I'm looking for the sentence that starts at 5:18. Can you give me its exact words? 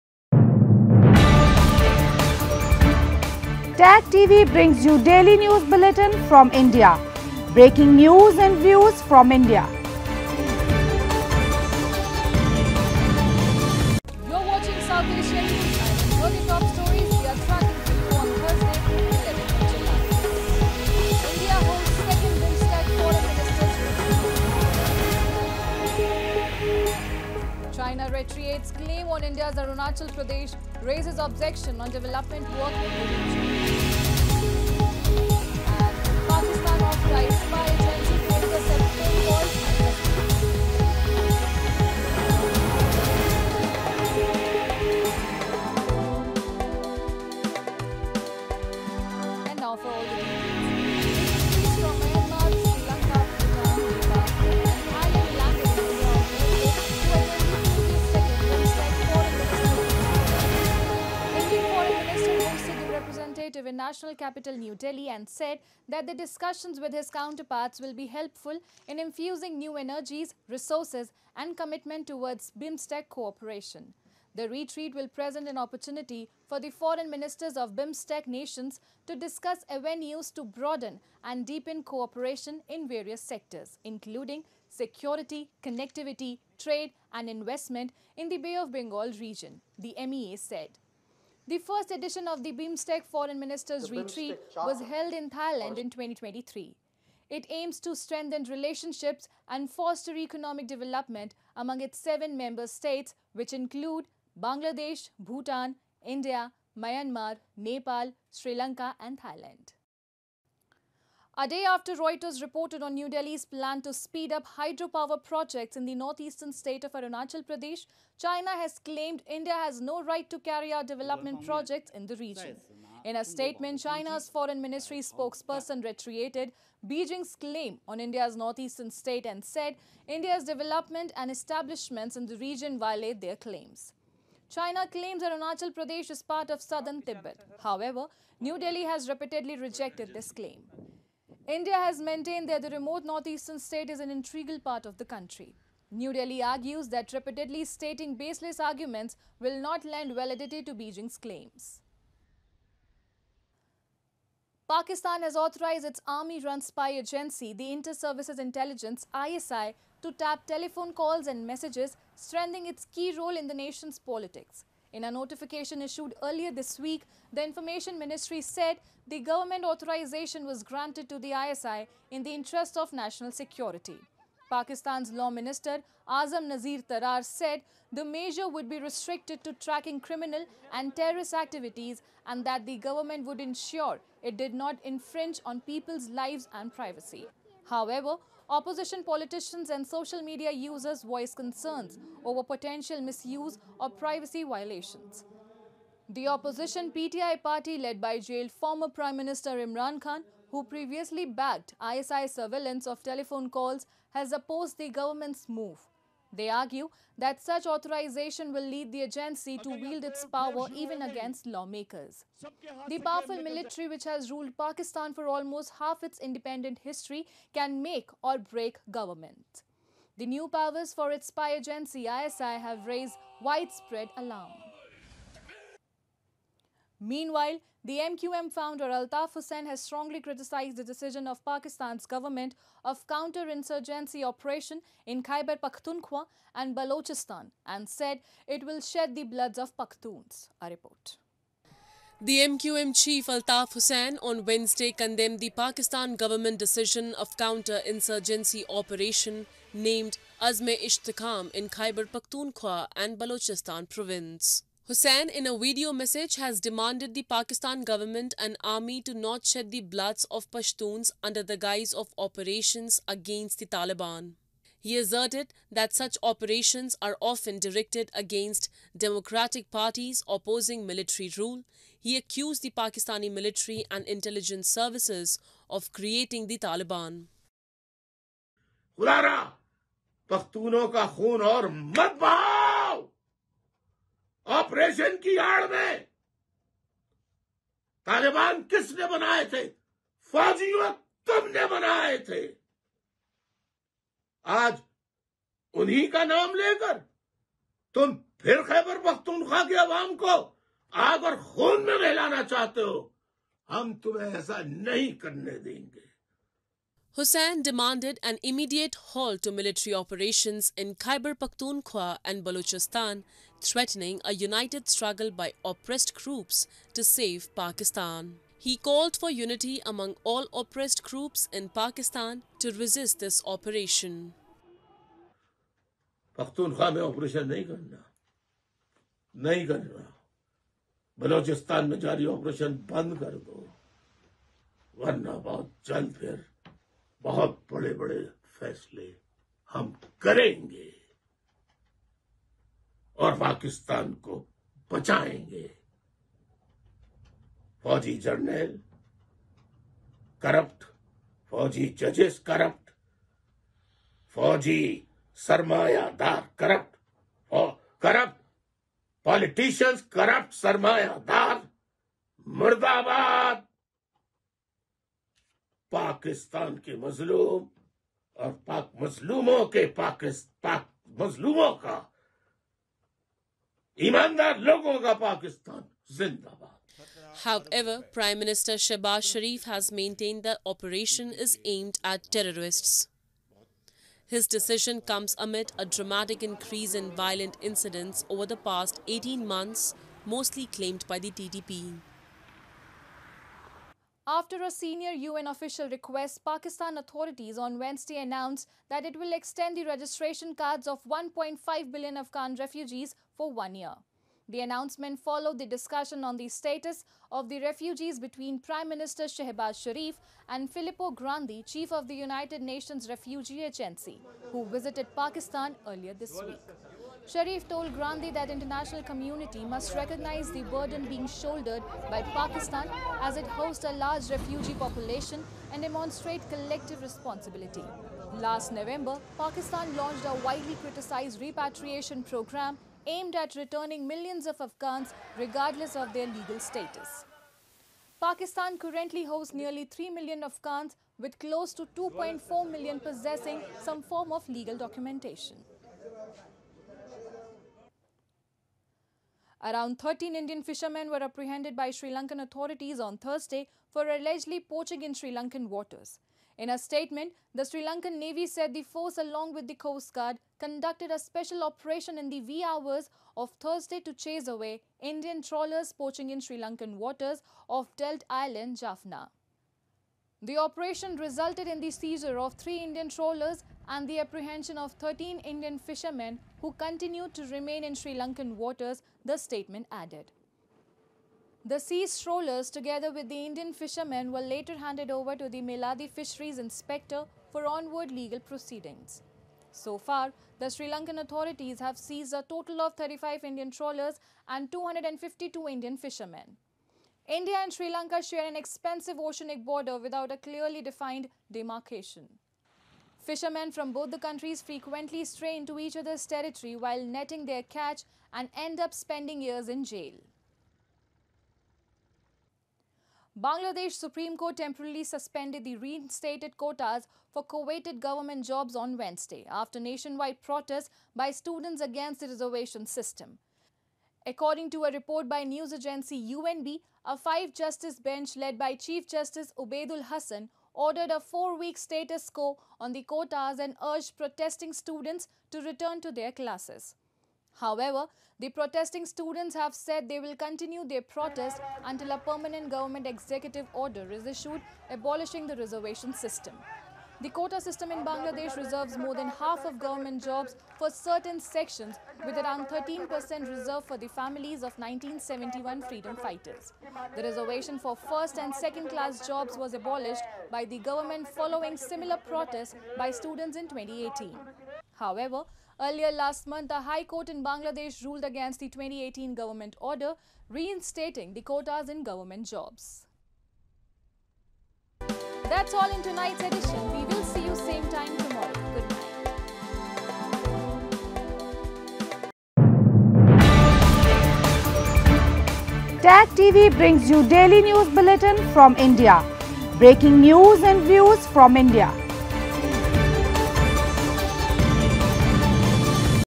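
He called for unity among all oppressed groups in Pakistan to resist this operation.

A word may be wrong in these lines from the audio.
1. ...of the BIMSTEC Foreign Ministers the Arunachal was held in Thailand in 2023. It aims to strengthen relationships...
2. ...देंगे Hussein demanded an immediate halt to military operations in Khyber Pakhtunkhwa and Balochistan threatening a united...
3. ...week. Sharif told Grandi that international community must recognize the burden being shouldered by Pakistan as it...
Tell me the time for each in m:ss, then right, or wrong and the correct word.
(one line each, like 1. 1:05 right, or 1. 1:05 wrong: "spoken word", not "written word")
1. 1:32 wrong: "Retreat", not "Arunachal"
2. 5:05 right
3. 6:56 right.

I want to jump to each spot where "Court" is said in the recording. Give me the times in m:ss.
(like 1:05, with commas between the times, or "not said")
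8:34, 9:27.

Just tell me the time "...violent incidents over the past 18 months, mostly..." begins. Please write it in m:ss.
6:27.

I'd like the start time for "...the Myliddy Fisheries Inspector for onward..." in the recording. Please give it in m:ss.
8:05.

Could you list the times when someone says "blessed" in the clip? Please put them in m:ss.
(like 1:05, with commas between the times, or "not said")
not said.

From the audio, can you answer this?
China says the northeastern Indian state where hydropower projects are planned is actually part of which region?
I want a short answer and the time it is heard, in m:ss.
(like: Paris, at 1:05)
Southern Tibet, at 2:16.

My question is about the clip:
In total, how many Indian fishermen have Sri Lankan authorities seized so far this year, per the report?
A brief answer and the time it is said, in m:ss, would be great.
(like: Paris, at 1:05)
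252, at 8:14.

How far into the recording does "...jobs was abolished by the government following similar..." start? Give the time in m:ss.
9:19.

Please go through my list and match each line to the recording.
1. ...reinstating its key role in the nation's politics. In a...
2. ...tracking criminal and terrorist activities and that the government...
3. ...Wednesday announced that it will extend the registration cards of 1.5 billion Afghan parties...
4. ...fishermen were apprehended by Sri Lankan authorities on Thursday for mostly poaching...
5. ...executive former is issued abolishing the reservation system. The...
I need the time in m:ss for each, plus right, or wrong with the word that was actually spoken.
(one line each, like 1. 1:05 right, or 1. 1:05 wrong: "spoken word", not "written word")
1. 2:42 wrong: "strengthening", not "reinstating"
2. 2:59 right
3. 6:37 wrong: "refugees", not "parties"
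4. 7:30 wrong: "allegedly", not "mostly"
5. 9:03 wrong: "order", not "former".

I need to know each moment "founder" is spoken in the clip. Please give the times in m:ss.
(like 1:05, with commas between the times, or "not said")
3:48.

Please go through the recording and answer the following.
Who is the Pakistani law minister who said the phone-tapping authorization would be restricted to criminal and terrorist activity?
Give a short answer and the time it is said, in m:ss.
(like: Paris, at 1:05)
Azam Nazir Tarar, at 2:56.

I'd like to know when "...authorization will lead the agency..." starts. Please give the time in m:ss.
3:27.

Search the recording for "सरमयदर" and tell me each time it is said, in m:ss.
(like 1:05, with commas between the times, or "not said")
5:55, 6:00.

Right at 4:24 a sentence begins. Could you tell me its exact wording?
He asserted that such operations are often directed against democratic parties opposing military rule.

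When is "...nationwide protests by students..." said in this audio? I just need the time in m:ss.
8:39.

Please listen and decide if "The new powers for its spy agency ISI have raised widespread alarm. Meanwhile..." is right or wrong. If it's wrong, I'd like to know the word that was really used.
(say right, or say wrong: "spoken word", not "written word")
right.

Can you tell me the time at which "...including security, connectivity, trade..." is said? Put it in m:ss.
1:23.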